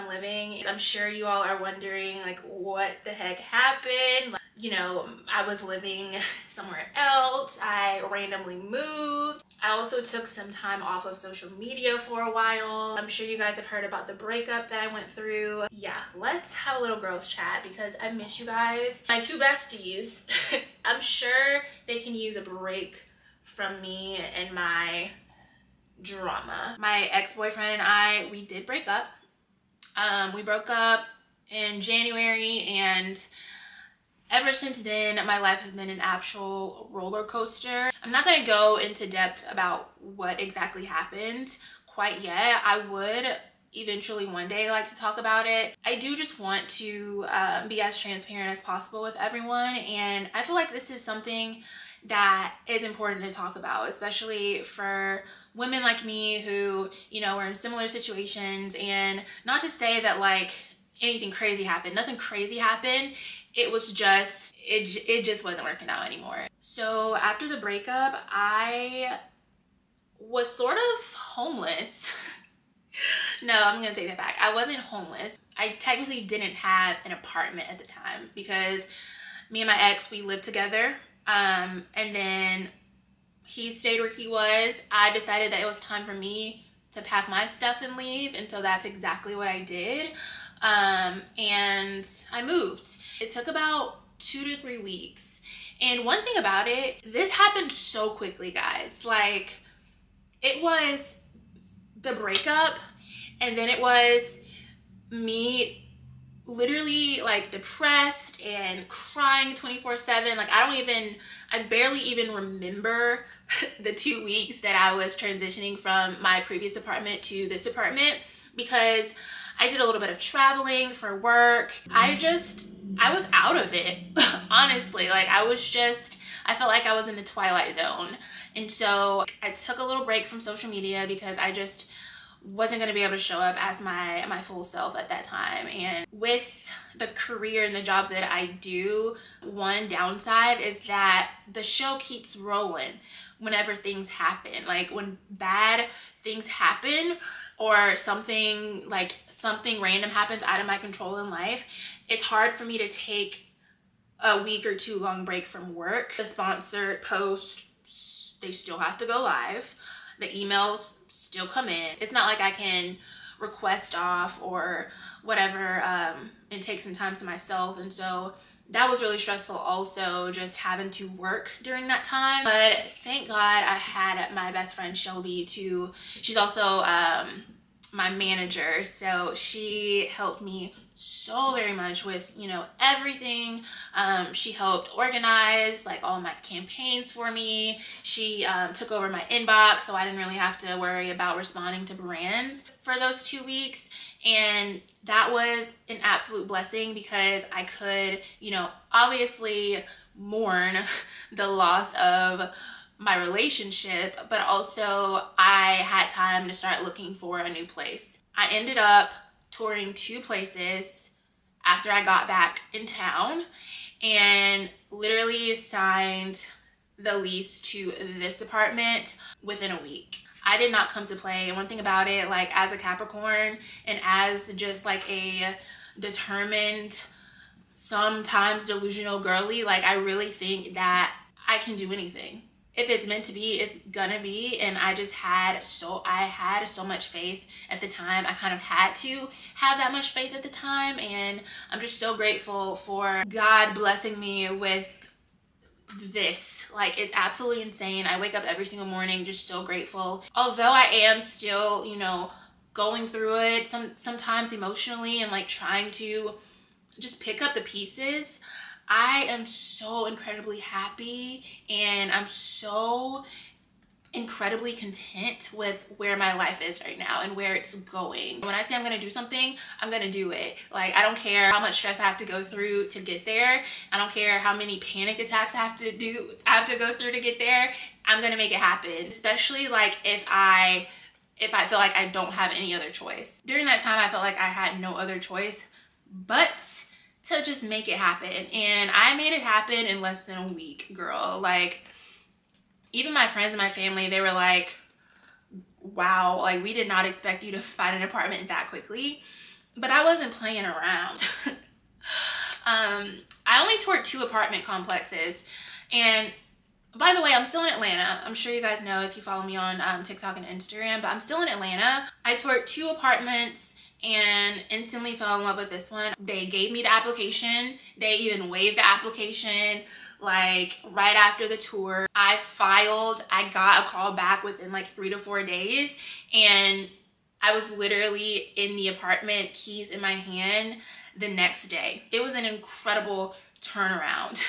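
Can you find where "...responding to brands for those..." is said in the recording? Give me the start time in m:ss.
3:11.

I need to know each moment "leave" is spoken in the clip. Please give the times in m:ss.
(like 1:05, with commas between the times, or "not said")
1:27.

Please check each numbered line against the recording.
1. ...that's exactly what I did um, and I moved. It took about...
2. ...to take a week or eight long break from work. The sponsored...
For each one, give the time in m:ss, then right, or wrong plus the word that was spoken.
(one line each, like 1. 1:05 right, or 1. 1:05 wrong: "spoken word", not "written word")
1. 1:28 right
2. 2:32 wrong: "two", not "eight".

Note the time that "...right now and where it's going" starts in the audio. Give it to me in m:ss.
4:26.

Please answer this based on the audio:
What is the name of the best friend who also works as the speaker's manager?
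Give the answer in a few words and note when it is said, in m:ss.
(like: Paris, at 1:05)
Shelby, at 2:54.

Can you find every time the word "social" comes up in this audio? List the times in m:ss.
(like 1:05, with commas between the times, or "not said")
0:11, 2:10.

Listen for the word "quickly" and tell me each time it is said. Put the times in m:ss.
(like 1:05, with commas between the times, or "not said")
1:38, 4:58.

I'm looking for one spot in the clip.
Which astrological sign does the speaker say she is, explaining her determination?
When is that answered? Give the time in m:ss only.
3:42.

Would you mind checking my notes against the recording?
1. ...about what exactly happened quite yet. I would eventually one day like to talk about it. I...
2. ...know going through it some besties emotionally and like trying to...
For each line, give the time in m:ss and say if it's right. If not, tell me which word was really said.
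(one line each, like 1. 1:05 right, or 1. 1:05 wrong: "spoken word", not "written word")
1. 0:39 right
2. 4:11 wrong: "sometimes", not "besties".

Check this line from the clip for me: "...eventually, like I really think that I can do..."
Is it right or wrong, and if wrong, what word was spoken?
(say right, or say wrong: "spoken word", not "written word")
wrong: "girly", not "eventually".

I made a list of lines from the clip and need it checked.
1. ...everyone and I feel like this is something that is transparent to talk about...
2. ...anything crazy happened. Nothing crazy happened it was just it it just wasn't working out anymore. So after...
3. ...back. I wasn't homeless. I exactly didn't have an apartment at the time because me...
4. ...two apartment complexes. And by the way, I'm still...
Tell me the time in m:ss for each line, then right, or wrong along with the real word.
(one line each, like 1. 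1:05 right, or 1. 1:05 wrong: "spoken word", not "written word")
1. 0:49 wrong: "important", not "transparent"
2. 1:01 right
3. 1:14 wrong: "technically", not "exactly"
4. 5:04 right.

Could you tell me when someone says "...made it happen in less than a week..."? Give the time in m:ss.
4:49.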